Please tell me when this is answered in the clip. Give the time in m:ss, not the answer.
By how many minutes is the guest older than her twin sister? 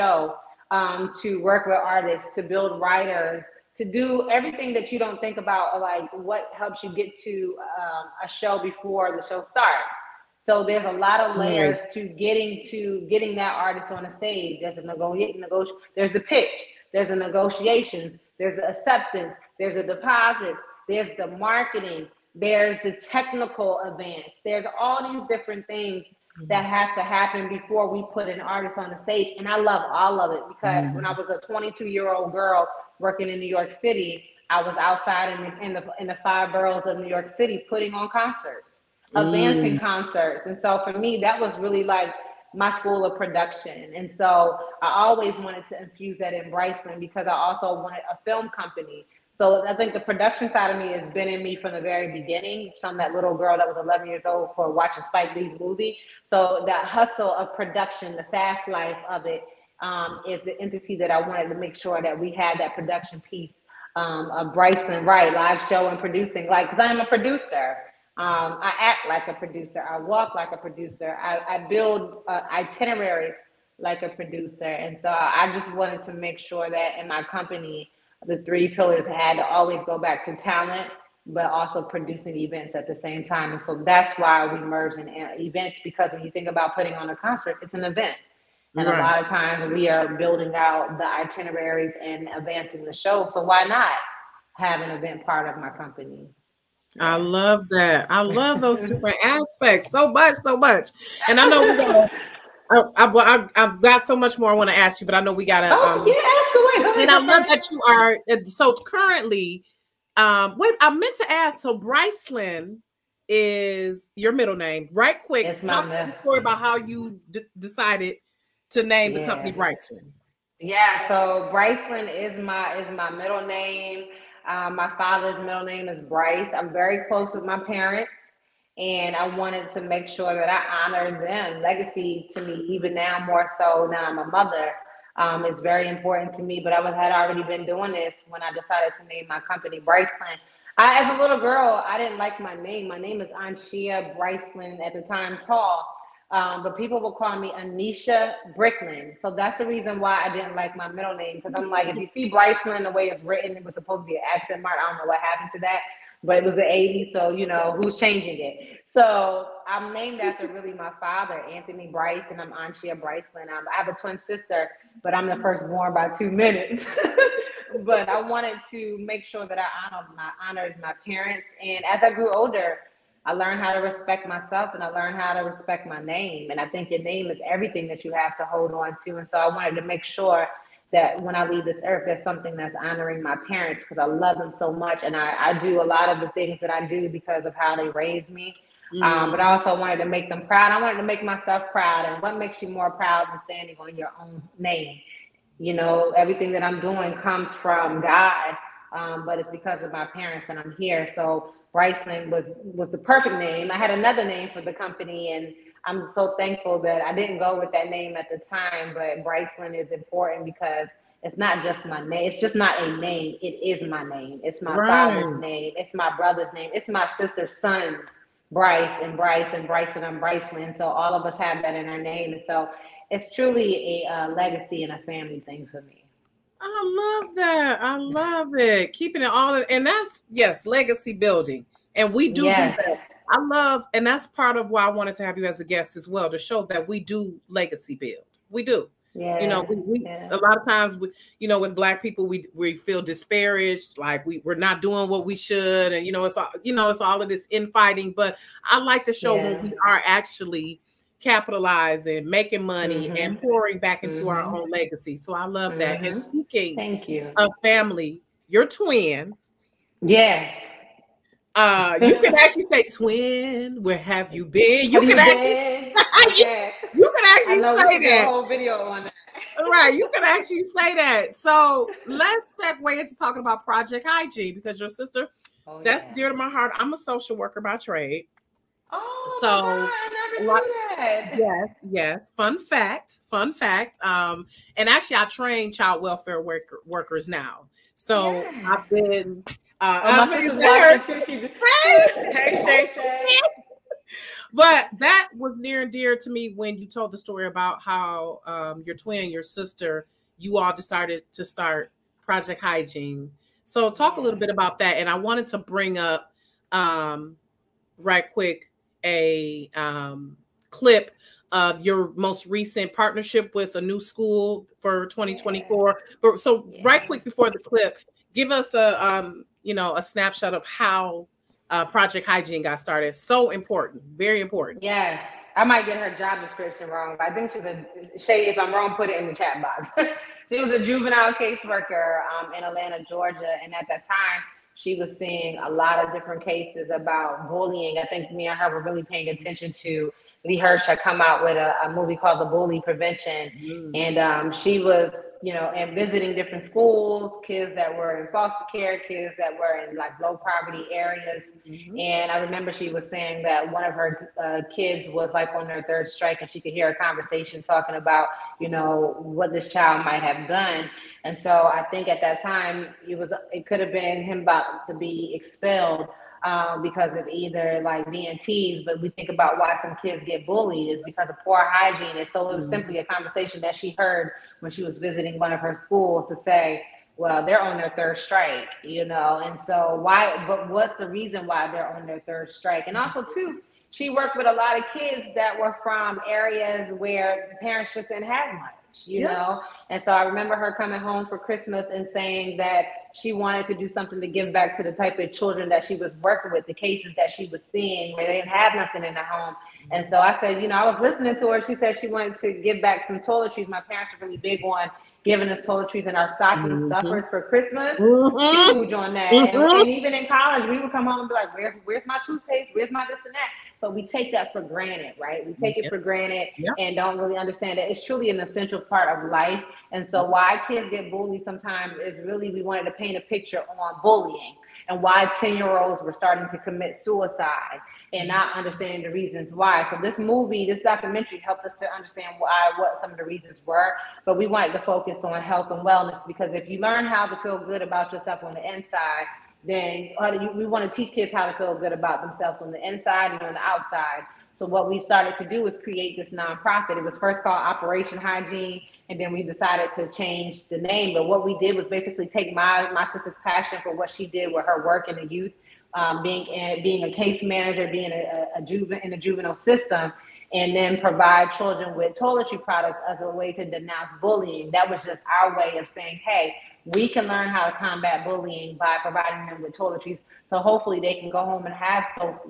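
2:46.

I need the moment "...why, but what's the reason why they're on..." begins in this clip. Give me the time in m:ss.
6:20.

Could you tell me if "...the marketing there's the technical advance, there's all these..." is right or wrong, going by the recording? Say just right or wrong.
right.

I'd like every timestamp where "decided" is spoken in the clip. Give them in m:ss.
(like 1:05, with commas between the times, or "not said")
1:57, 2:18, 5:00, 7:29.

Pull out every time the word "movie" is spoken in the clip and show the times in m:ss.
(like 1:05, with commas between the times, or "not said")
0:55, 5:41, 7:10.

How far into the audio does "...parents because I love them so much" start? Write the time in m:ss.
3:03.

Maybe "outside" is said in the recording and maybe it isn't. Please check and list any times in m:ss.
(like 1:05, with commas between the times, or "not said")
0:34, 7:23.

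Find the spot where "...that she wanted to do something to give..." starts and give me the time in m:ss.
6:32.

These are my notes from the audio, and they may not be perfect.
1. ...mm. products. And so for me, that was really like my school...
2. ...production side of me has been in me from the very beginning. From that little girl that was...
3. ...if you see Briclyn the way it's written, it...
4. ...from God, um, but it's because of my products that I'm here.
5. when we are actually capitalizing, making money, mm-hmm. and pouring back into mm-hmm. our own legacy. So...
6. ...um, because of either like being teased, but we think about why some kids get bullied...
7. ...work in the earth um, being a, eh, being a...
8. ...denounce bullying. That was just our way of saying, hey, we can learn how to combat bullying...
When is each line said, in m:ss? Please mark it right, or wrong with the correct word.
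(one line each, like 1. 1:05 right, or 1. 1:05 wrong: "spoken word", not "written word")
1. 0:39 wrong: "concerts", not "products"
2. 0:49 right
3. 2:31 right
4. 3:17 wrong: "parents", not "products"
5. 4:09 right
6. 6:06 right
7. 7:34 wrong: "youth", not "earth"
8. 7:43 right.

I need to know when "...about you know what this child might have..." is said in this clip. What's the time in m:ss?
5:57.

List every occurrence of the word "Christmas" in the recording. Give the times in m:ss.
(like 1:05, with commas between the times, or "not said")
6:31, 6:47.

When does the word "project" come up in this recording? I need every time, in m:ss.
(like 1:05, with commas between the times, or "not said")
4:33, 5:02, 5:21.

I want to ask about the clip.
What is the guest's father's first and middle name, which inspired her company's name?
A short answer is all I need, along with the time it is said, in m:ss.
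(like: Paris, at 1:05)
Anthony Bryce, at 2:41.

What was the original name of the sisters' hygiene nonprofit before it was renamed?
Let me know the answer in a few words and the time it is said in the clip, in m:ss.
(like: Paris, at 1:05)
Operation Hygiene, at 7:27.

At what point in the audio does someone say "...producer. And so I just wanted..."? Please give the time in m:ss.
1:14.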